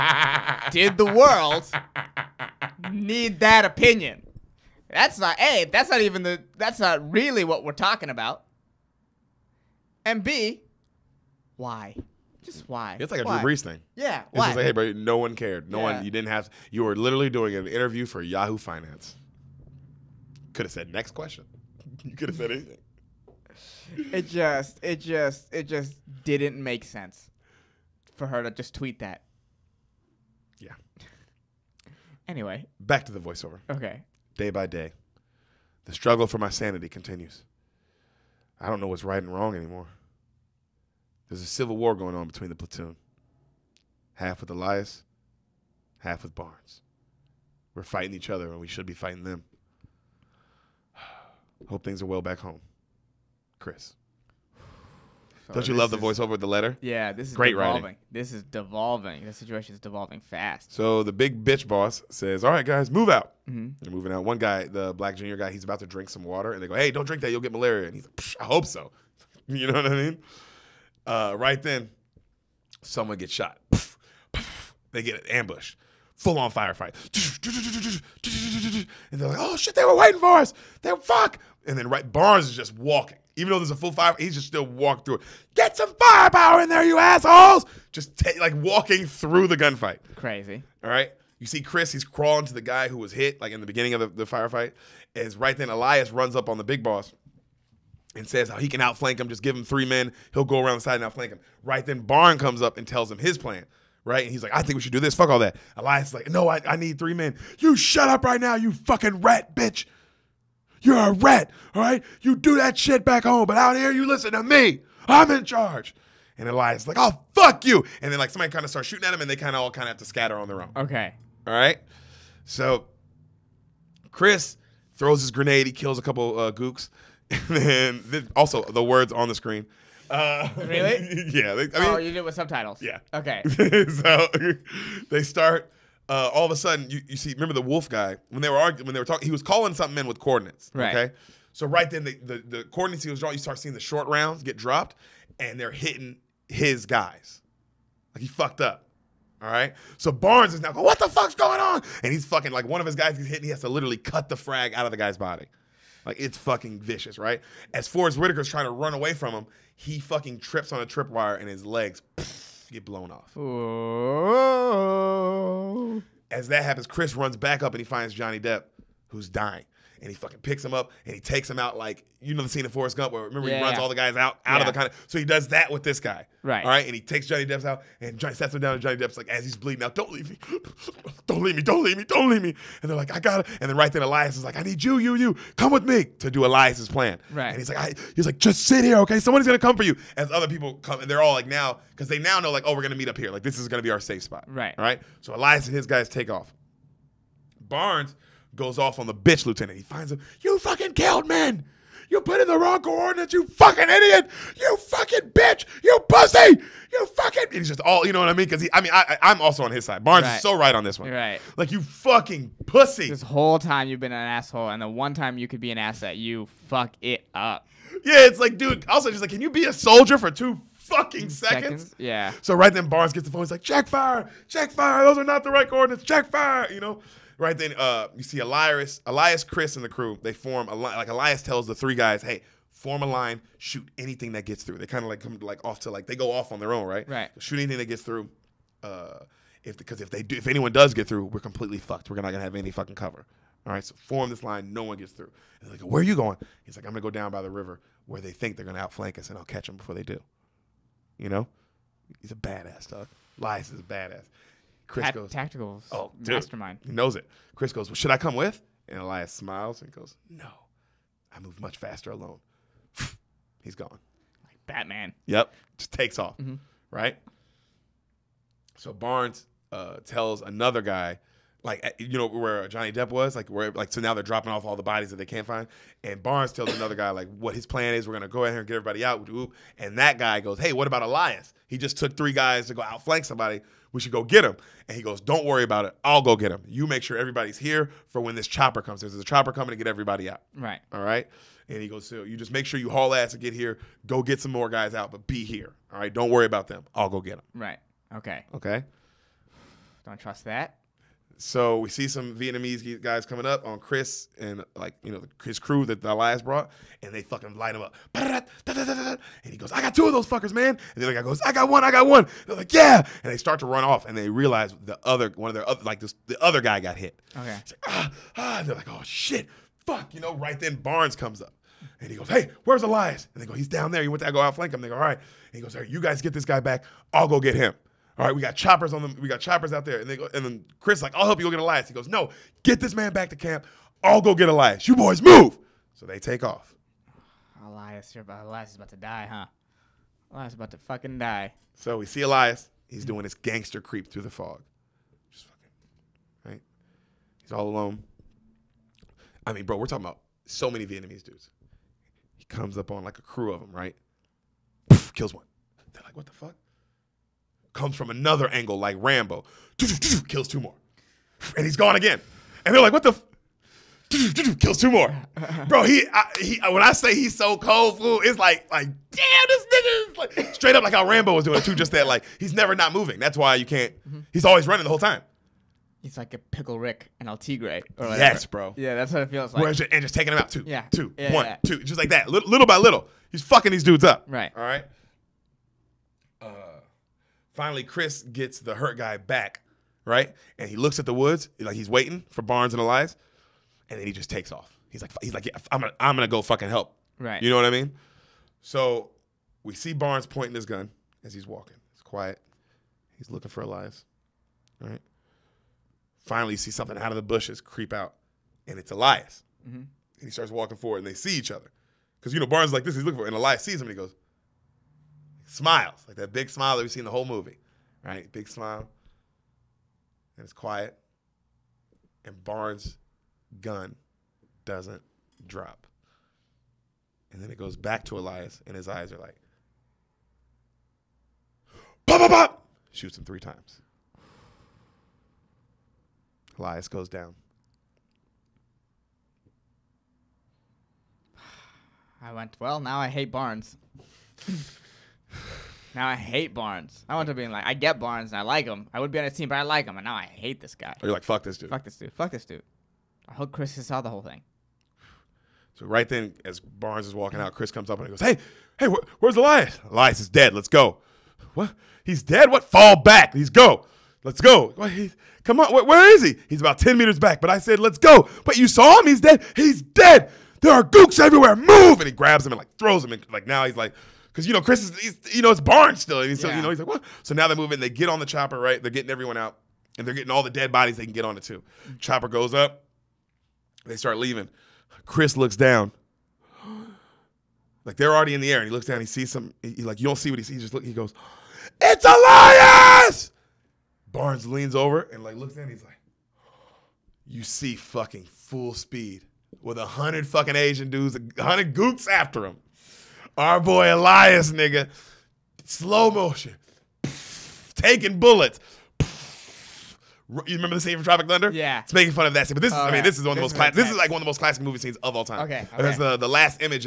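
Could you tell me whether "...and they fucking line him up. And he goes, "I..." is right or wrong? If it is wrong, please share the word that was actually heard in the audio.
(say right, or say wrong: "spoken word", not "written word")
right.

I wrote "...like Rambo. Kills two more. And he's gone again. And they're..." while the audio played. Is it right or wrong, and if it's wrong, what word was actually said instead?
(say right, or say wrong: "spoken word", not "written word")
right.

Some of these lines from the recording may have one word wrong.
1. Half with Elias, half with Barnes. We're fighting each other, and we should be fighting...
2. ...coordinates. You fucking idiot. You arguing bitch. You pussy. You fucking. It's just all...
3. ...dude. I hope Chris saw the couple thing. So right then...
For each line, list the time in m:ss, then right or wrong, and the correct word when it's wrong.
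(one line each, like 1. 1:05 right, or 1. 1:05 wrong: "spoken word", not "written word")
1. 0:44 right
2. 3:22 wrong: "fucking", not "arguing"
3. 7:32 wrong: "whole", not "couple".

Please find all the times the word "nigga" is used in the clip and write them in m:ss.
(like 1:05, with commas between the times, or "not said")
6:09, 8:24.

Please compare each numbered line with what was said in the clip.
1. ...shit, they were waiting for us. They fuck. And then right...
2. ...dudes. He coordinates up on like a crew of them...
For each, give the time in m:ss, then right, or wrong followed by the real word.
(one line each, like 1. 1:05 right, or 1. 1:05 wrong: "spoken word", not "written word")
1. 1:19 right
2. 5:51 wrong: "comes", not "coordinates".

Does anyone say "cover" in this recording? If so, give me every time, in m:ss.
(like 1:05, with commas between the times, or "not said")
4:02.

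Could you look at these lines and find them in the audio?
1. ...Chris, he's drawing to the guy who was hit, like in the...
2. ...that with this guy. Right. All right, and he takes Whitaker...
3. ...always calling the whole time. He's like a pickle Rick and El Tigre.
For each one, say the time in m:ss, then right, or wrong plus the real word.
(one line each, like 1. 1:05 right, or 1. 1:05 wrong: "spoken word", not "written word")
1. 1:31 wrong: "crawling", not "drawing"
2. 2:55 wrong: "Johnny", not "Whitaker"
3. 6:14 wrong: "running", not "calling".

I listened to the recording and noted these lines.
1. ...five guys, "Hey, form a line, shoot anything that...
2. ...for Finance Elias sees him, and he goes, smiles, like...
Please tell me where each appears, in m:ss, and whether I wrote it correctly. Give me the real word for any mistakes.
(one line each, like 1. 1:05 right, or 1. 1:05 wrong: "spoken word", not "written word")
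1. 3:51 wrong: "three", not "five"
2. 6:53 wrong: "And", not "Finance".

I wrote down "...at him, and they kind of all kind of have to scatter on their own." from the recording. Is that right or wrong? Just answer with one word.
right.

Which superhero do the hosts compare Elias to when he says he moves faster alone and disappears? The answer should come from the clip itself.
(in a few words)
Batman.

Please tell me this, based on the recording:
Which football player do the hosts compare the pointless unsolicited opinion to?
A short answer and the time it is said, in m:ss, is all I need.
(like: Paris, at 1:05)
Drew Brees, at 0:13.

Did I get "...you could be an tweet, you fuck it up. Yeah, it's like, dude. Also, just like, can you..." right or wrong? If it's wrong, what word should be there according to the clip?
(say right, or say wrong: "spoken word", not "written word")
wrong: "asset", not "tweet".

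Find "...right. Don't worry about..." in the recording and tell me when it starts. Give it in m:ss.
4:55.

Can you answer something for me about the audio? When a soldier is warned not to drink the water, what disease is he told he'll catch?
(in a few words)
Malaria.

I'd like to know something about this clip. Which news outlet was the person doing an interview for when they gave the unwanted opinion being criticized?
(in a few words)
Yahoo Finance.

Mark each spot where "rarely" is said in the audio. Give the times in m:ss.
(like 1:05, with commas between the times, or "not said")
not said.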